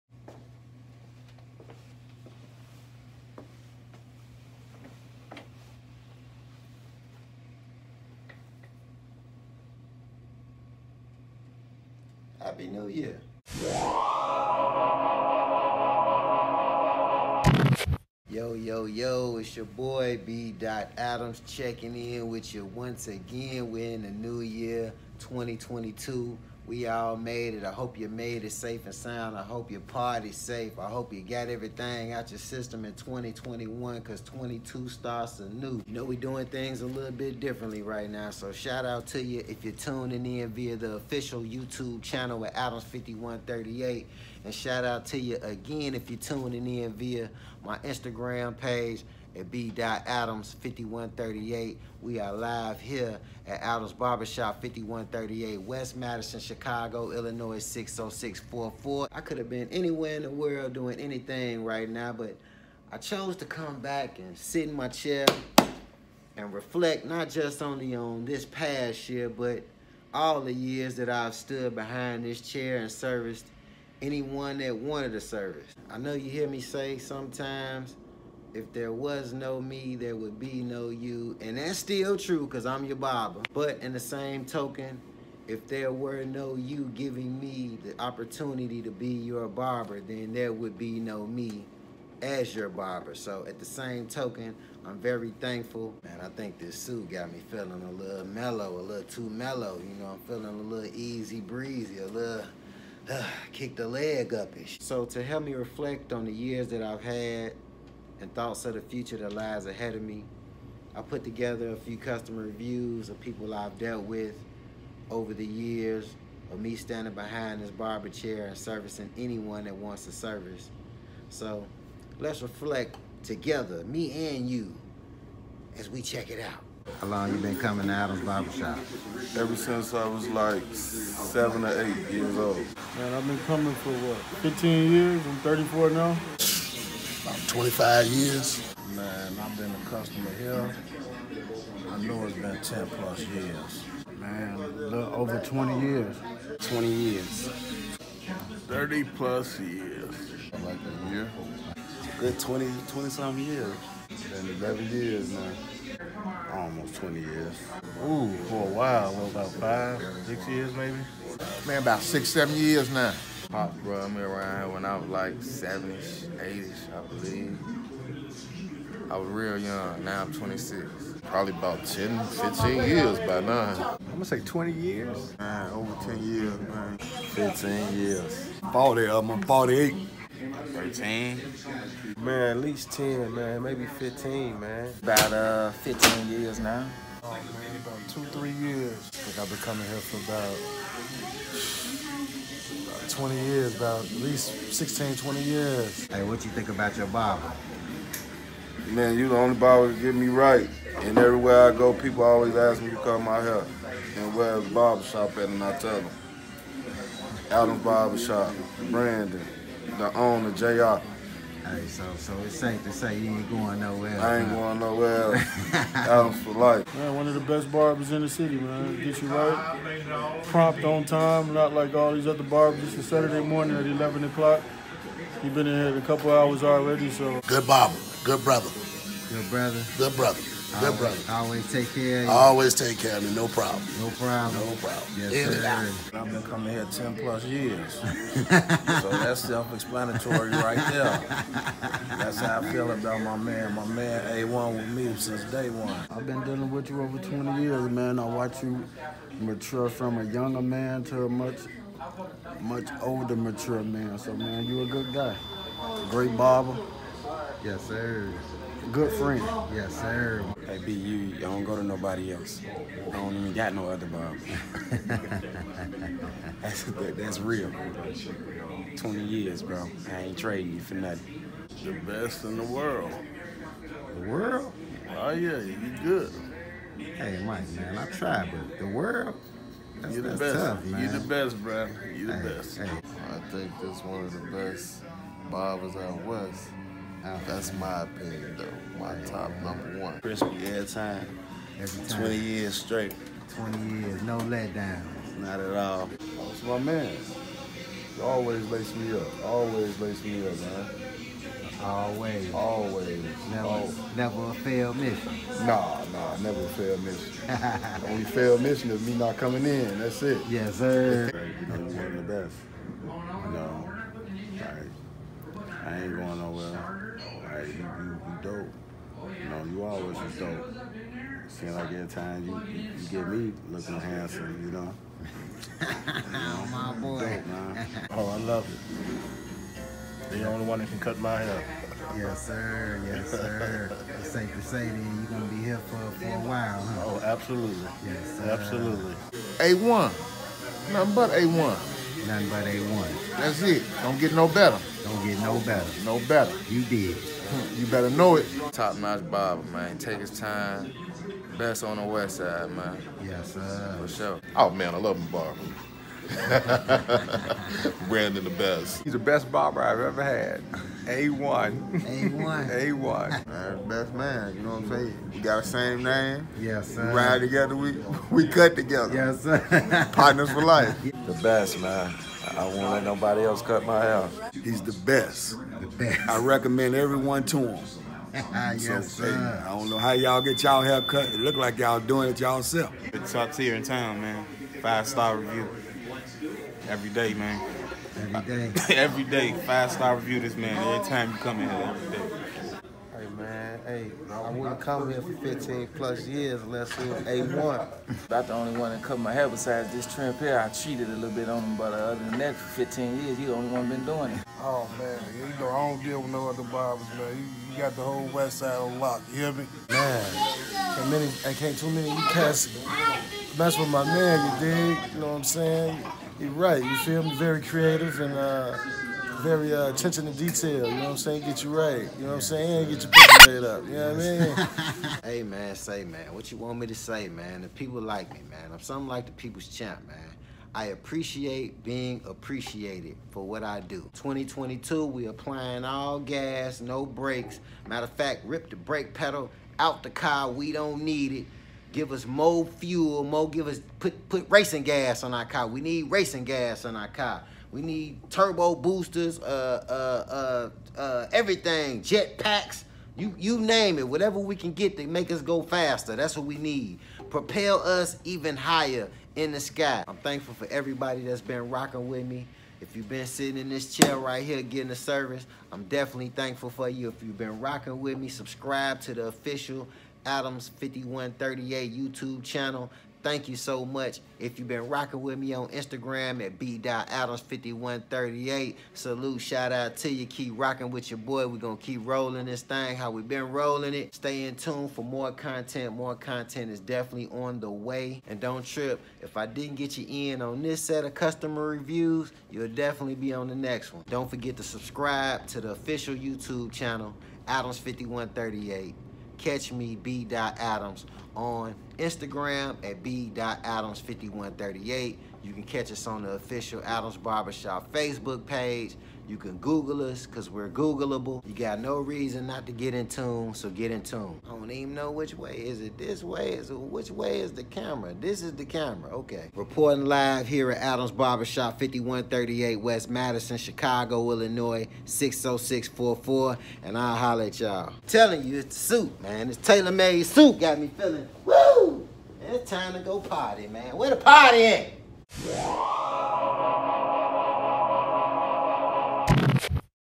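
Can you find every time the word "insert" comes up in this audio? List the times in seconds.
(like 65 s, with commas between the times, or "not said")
not said.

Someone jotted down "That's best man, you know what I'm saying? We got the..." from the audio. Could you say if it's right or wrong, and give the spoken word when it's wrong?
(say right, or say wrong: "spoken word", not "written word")
right.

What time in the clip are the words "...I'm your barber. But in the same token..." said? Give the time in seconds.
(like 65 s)
82 s.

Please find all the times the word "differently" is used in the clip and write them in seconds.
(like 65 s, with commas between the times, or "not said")
37 s.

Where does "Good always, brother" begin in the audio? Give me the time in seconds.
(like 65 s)
230 s.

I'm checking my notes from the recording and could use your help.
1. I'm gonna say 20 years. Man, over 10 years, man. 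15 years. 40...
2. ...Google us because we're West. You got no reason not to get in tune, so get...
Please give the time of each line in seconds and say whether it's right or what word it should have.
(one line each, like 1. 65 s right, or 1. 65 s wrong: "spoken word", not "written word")
1. 174 s right
2. 509 s wrong: "Googleable", not "West".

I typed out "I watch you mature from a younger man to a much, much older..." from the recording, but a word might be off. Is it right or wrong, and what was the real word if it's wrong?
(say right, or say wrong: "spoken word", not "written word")
right.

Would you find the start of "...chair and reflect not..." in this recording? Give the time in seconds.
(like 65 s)
64 s.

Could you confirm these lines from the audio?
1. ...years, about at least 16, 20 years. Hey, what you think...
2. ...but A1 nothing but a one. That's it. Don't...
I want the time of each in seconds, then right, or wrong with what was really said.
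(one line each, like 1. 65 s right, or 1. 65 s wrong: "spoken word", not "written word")
1. 193 s right
2. 341 s right.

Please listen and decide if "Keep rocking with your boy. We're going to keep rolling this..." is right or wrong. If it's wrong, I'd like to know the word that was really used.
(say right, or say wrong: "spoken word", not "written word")
right.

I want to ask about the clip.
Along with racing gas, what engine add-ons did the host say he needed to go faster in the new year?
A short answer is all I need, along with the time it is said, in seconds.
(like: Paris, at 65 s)
Turbo boosters, at 448 s.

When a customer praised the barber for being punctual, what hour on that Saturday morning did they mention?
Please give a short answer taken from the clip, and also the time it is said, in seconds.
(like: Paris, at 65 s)
11 o'clock, at 223 s.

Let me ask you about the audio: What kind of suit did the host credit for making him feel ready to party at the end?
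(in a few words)
Tailor-made.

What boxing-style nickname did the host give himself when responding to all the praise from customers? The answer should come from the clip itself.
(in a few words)
The people's champ.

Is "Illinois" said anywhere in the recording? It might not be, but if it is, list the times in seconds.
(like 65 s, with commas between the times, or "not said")
57 s, 524 s.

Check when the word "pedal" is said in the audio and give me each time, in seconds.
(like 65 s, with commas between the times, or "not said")
439 s.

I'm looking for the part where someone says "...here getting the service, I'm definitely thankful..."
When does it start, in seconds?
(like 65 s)
464 s.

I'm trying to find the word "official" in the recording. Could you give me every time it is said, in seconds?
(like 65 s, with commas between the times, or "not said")
40 s, 469 s, 495 s, 506 s.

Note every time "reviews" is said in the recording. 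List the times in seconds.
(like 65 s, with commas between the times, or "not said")
112 s, 385 s, 390 s, 491 s.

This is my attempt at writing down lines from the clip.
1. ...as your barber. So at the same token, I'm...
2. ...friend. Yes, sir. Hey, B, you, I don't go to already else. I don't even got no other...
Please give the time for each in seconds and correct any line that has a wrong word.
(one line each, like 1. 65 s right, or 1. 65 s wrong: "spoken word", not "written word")
1. 92 s right
2. 259 s wrong: "nobody", not "already".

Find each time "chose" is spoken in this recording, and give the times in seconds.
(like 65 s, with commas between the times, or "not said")
62 s.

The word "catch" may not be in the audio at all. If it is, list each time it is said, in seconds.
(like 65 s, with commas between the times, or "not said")
499 s, 505 s.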